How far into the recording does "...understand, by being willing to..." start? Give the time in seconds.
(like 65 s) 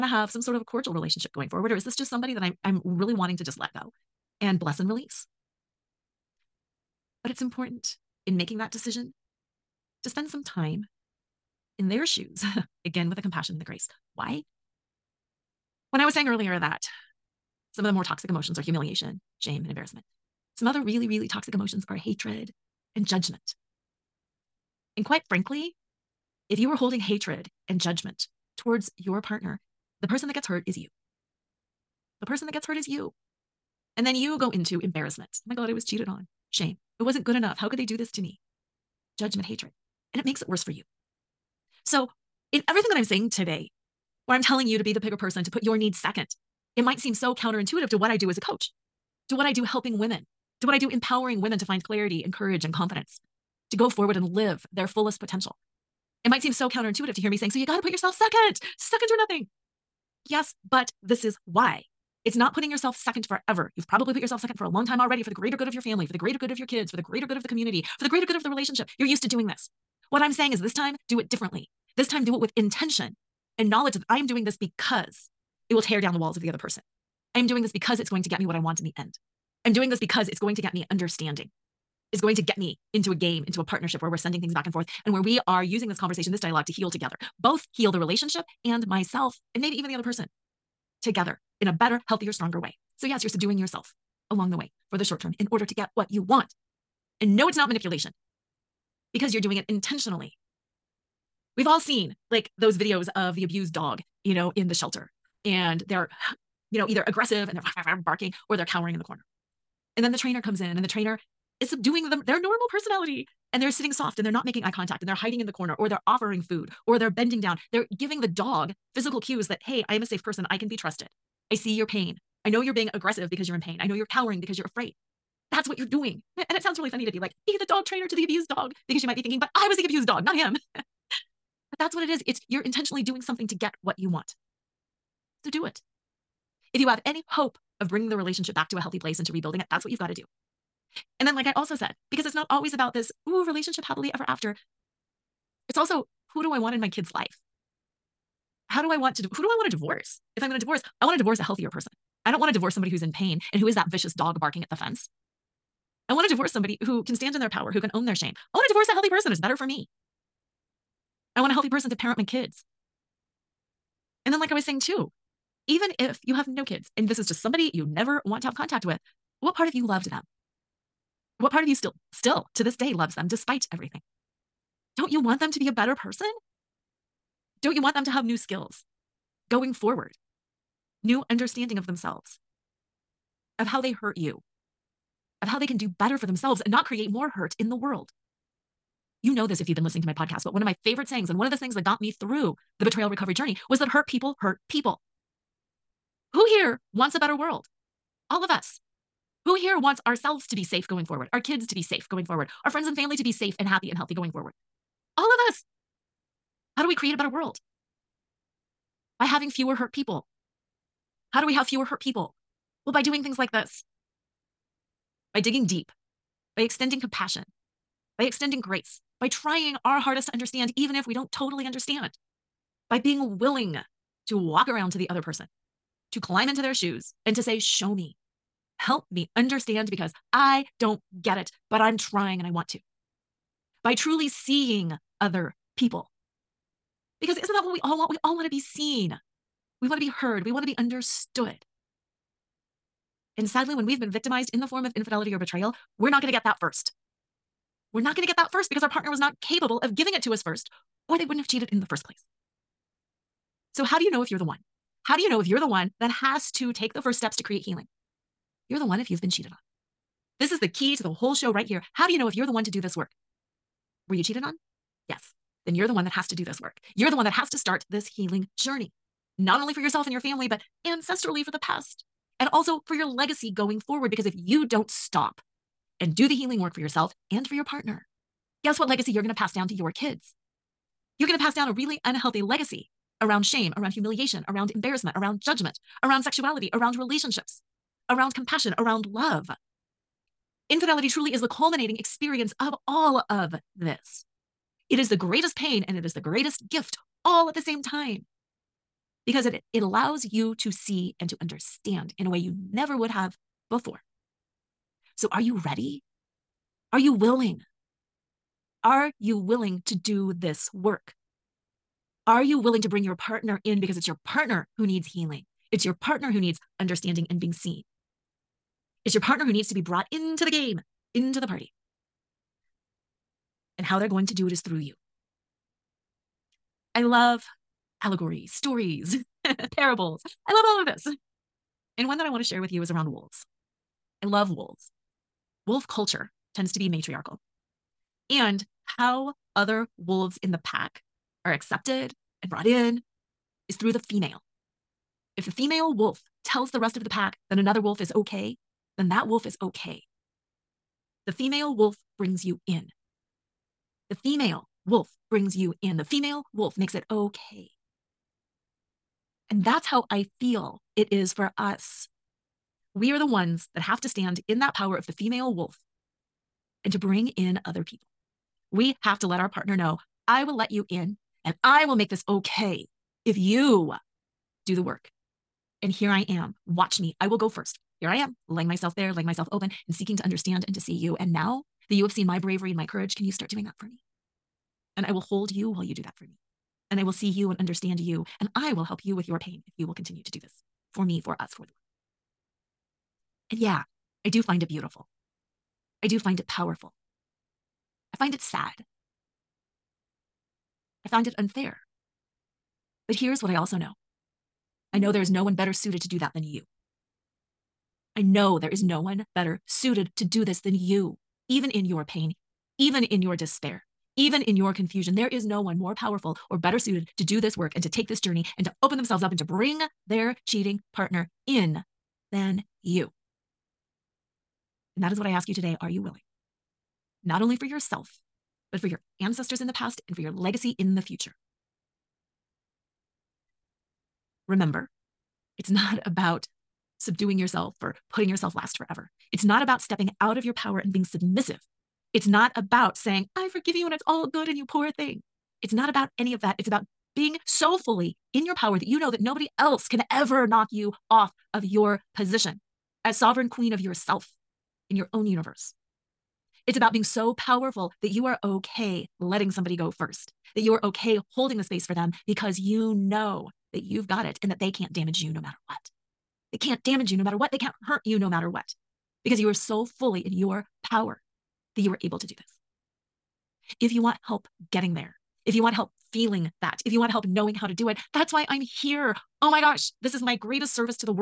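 221 s.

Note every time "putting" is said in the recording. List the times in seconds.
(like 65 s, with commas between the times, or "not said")
62 s, 438 s.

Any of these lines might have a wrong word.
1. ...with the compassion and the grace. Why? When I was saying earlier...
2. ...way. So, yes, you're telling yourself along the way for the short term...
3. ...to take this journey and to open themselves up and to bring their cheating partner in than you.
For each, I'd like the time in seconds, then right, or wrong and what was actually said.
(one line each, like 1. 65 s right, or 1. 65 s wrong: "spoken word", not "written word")
1. 13 s right
2. 92 s wrong: "subduing", not "telling"
3. 417 s right.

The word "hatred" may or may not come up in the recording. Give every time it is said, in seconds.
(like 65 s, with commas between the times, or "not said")
21 s, 26 s, 39 s.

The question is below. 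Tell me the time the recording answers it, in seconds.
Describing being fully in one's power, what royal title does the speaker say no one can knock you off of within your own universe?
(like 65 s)
453 s.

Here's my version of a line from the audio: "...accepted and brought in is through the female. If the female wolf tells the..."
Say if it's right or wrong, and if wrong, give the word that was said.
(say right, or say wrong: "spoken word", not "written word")
right.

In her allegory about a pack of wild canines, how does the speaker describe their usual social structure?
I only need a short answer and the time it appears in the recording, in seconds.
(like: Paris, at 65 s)
matriarchal, at 336 s.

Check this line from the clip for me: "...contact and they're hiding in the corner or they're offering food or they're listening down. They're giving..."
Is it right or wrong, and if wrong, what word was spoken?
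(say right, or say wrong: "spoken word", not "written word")
wrong: "bending", not "listening".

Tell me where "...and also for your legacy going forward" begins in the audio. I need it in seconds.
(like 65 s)
272 s.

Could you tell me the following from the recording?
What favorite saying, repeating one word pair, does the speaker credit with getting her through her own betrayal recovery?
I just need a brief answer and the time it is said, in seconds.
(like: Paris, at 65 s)
hurt people hurt people, at 193 s.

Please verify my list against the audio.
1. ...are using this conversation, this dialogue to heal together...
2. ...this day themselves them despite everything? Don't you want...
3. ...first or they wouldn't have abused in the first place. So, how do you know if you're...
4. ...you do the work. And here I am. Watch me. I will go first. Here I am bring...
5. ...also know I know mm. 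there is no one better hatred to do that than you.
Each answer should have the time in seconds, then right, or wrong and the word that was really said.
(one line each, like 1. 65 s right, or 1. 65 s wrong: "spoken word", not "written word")
1. 85 s right
2. 172 s wrong: "loves", not "themselves"
3. 250 s wrong: "cheated", not "abused"
4. 373 s wrong: "laying", not "bring"
5. 403 s wrong: "suited", not "hatred".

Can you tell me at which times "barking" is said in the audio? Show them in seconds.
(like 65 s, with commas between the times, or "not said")
108 s, 154 s.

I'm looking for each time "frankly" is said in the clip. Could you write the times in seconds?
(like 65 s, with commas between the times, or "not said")
25 s.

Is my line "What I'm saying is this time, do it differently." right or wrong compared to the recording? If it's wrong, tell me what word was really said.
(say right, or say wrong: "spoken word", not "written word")
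right.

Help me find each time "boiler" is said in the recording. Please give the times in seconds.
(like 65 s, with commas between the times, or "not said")
not said.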